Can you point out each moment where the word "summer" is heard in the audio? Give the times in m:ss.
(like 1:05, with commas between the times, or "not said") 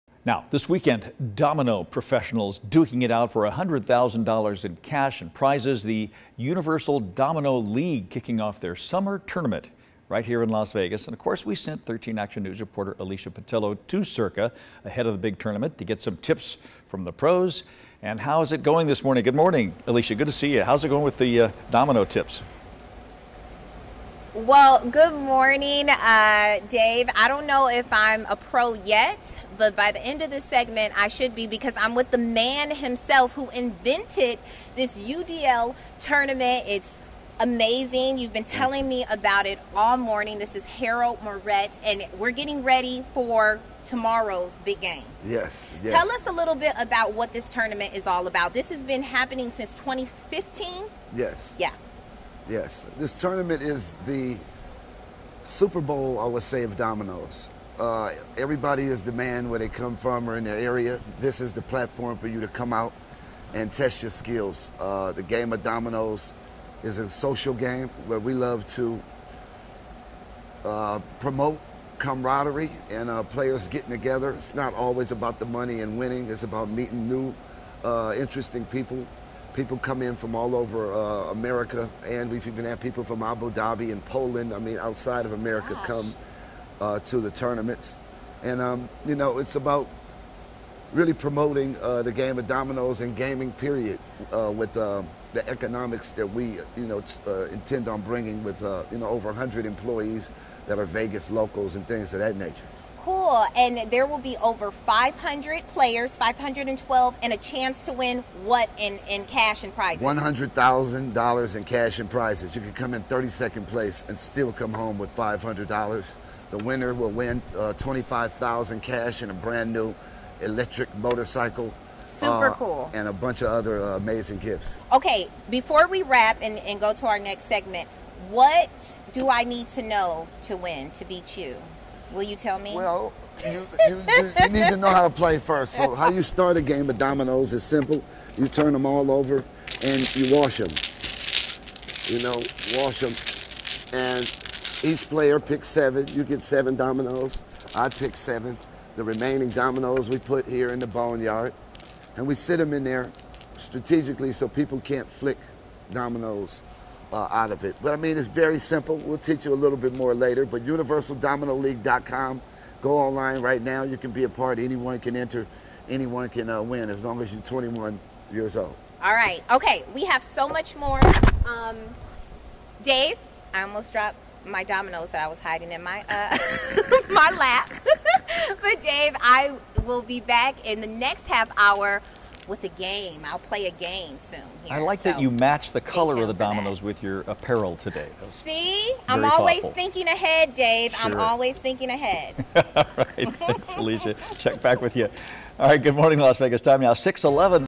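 0:08.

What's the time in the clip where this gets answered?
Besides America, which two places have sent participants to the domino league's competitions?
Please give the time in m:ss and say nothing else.
1:23.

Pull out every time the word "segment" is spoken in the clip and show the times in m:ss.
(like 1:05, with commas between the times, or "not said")
0:30, 2:07.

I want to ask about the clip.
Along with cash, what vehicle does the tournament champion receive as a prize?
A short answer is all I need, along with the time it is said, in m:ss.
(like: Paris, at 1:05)
Electric motorcycle, at 2:00.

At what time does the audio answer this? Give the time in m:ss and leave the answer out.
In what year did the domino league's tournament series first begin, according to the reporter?
0:49.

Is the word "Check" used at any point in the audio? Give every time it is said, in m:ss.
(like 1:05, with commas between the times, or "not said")
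3:14.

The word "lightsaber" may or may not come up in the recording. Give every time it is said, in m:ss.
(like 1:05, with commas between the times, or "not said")
not said.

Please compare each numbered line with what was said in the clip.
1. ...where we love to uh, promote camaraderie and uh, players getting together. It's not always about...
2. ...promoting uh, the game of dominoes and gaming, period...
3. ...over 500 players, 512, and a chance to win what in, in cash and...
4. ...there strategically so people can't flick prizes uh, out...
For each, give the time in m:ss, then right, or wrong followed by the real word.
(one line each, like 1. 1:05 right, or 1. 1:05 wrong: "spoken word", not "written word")
1. 1:08 right
2. 1:31 right
3. 1:44 right
4. 2:32 wrong: "dominoes", not "prizes".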